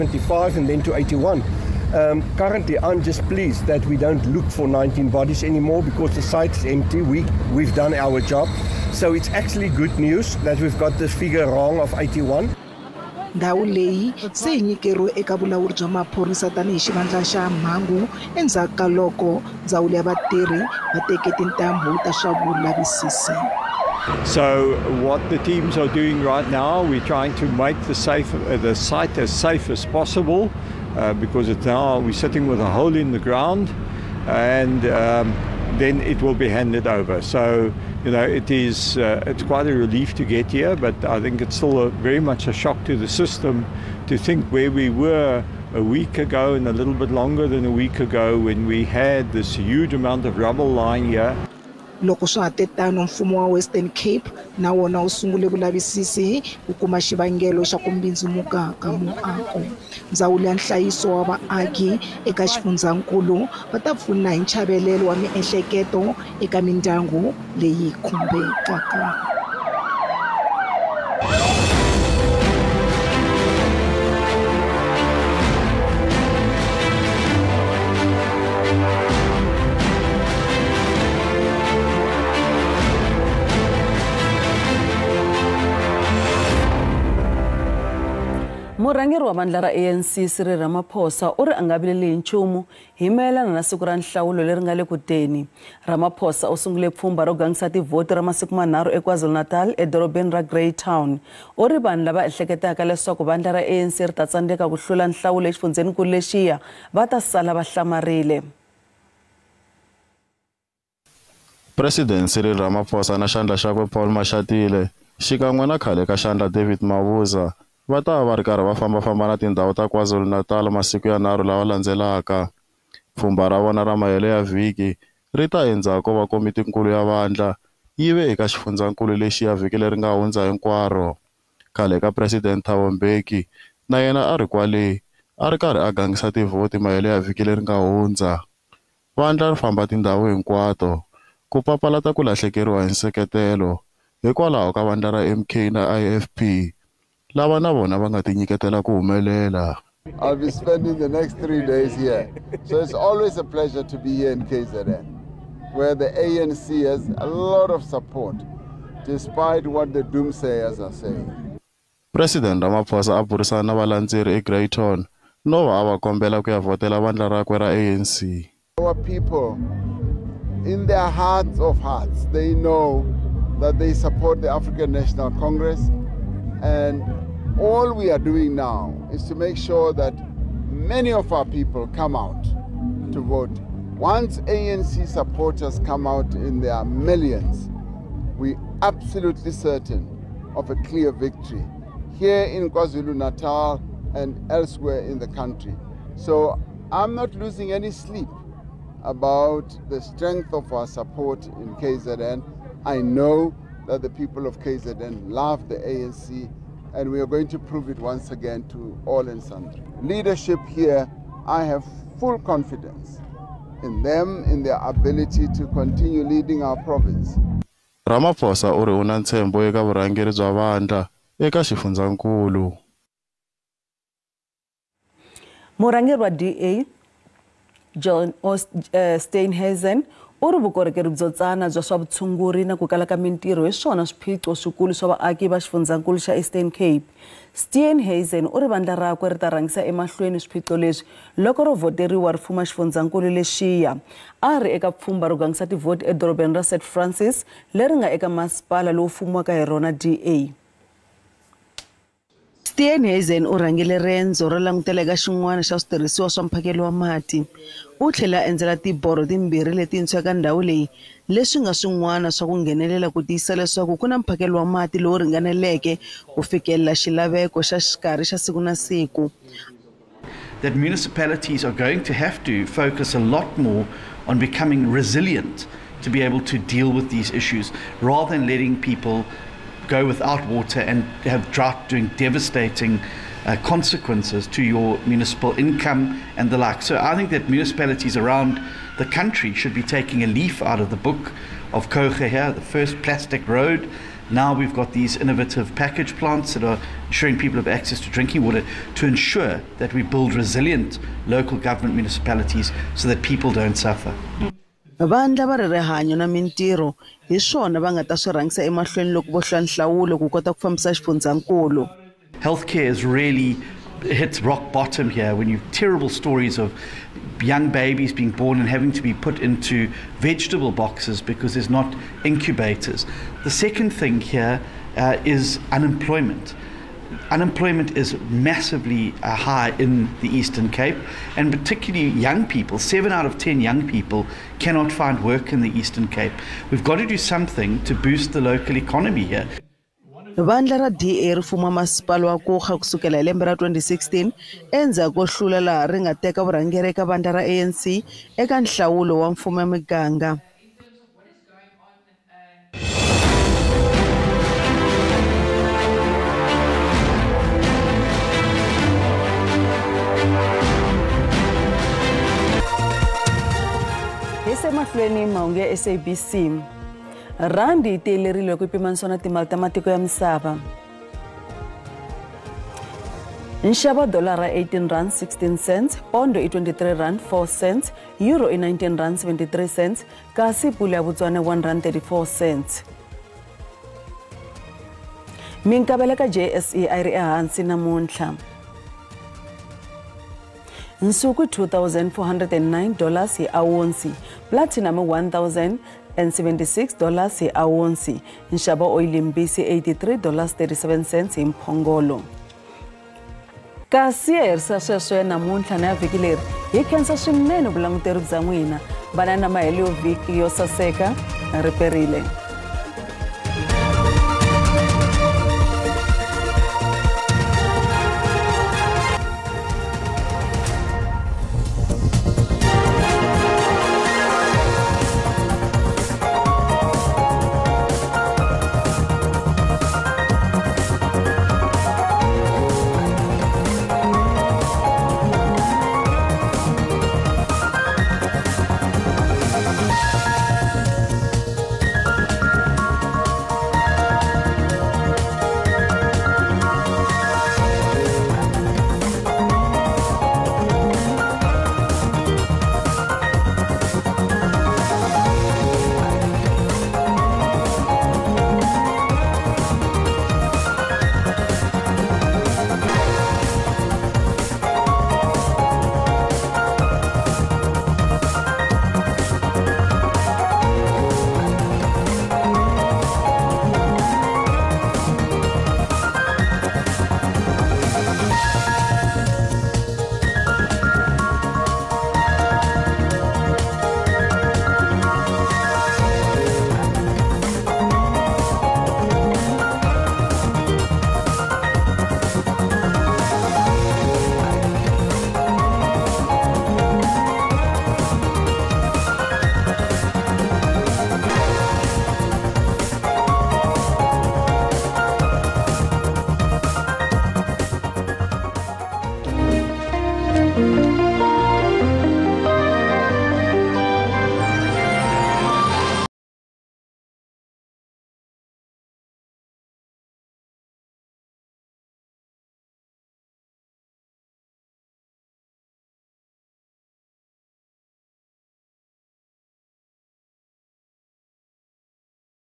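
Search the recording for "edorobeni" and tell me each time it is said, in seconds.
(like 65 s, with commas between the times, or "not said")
99 s, 246 s.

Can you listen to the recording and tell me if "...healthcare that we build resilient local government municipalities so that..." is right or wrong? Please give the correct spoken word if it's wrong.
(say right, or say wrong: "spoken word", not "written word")
wrong: "ensure", not "healthcare".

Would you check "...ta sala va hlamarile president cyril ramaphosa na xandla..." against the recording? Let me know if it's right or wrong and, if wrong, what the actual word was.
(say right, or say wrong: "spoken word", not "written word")
right.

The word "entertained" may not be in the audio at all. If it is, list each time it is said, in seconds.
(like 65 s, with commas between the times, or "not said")
not said.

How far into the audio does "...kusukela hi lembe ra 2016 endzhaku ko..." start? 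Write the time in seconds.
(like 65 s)
342 s.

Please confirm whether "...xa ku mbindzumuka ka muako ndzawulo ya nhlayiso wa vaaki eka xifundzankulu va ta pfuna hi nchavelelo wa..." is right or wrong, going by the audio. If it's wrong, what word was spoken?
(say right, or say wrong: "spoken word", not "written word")
right.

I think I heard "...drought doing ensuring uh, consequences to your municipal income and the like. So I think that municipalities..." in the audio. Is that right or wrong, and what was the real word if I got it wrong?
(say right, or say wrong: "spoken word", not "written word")
wrong: "devastating", not "ensuring".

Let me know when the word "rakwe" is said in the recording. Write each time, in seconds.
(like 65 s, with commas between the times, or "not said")
167 s, 239 s.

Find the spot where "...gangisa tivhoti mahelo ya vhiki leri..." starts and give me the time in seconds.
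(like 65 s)
135 s.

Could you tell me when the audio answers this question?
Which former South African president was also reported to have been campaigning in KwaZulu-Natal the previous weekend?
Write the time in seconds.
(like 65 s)
132 s.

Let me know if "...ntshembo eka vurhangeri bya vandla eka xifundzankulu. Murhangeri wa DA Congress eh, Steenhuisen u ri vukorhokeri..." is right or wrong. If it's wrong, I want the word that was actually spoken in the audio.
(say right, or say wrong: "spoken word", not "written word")
wrong: "John", not "Congress".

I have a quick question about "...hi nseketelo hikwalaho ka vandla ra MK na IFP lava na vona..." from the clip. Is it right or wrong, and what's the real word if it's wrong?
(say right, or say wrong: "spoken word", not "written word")
right.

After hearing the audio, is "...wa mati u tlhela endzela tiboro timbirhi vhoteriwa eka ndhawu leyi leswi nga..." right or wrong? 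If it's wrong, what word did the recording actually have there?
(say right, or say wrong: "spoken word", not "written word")
wrong: "letintshwa", not "vhoteriwa".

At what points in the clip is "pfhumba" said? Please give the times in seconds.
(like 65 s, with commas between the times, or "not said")
96 s, 123 s, 244 s.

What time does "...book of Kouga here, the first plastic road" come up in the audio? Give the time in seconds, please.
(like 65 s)
290 s.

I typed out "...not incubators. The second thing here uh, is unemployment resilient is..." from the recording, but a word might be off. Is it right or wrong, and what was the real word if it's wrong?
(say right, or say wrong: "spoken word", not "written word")
wrong: "unemployment", not "resilient".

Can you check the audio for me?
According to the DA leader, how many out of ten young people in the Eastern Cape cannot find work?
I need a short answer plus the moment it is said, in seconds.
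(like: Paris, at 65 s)
7, at 332 s.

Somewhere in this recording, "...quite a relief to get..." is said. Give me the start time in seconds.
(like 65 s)
39 s.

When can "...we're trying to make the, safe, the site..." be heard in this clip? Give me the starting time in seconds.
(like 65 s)
26 s.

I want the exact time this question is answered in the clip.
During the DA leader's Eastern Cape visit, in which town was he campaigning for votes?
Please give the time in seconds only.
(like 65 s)
246 s.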